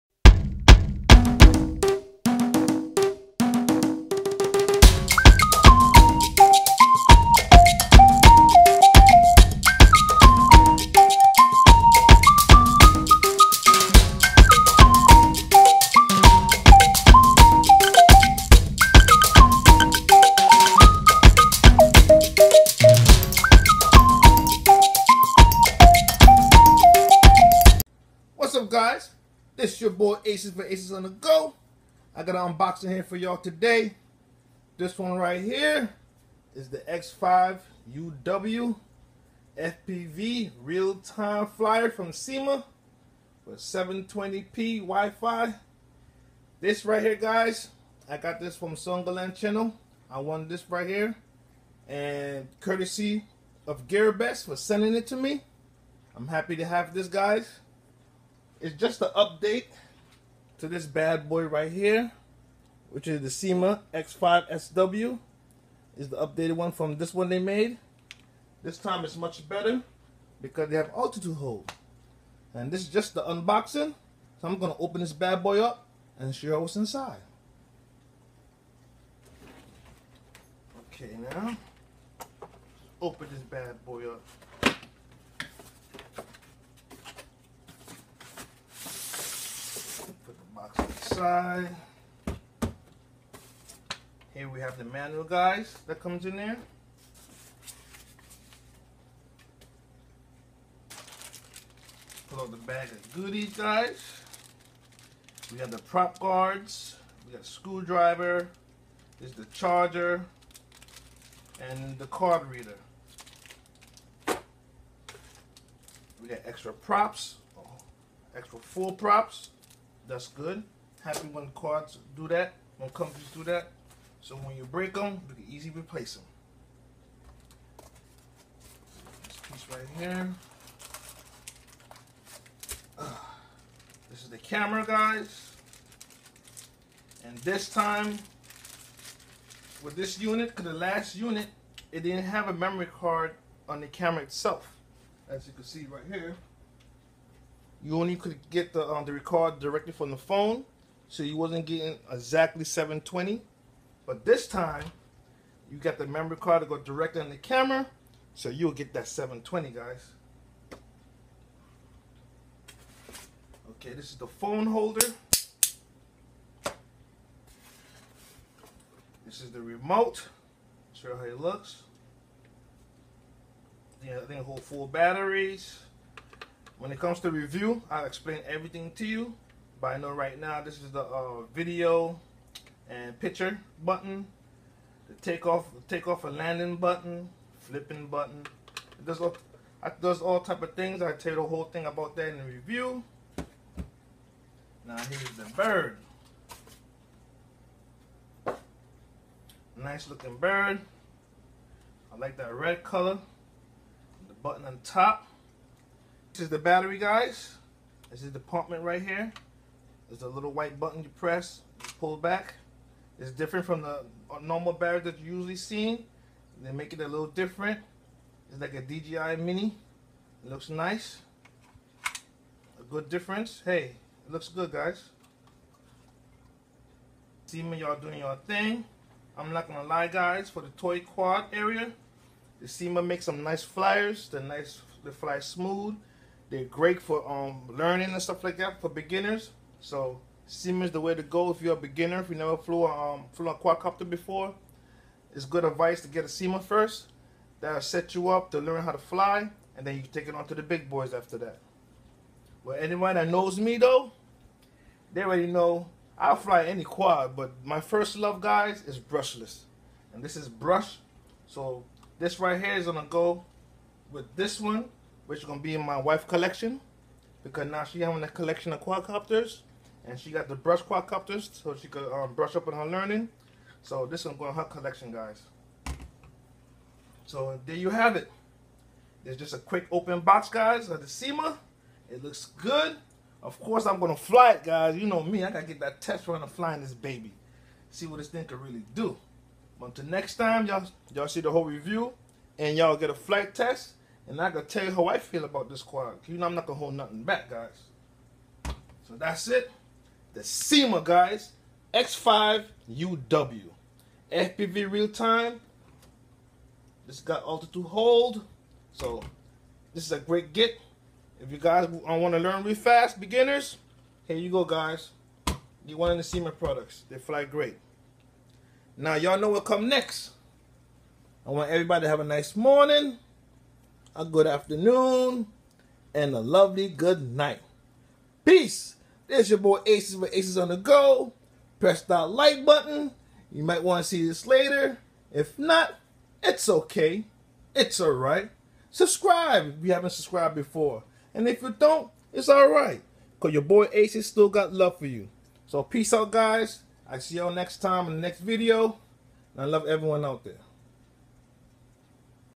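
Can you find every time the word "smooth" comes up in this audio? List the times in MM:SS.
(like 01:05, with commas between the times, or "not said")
03:55.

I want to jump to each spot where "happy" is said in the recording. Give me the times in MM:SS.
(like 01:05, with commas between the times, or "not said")
00:56, 02:01.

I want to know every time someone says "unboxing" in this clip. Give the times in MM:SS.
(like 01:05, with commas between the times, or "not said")
00:32, 01:13.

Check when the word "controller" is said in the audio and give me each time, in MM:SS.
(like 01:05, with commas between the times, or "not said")
not said.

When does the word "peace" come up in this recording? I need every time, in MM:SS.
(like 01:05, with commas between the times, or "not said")
05:28, 05:45.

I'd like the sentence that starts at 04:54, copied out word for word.
And I can tell you how I feel about this quad.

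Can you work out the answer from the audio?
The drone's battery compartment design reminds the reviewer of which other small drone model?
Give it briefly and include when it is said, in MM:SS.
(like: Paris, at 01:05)
DJI Mini, at 03:38.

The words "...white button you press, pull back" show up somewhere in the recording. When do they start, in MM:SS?
03:30.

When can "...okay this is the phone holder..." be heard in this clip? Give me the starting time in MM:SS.
02:43.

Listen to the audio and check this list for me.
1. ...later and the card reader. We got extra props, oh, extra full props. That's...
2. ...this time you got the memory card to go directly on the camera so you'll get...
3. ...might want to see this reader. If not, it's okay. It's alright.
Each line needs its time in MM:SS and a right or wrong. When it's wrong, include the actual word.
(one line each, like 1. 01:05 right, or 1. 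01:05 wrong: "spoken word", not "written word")
1. 01:49 wrong: "charger", not "later"
2. 02:34 right
3. 05:33 wrong: "later", not "reader".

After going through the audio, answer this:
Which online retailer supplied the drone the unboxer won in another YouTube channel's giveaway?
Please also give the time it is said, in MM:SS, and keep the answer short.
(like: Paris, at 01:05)
GearBest, at 00:53.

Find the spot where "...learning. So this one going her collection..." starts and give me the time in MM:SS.
04:32.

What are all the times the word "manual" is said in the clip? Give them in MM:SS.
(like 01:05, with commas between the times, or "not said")
01:34.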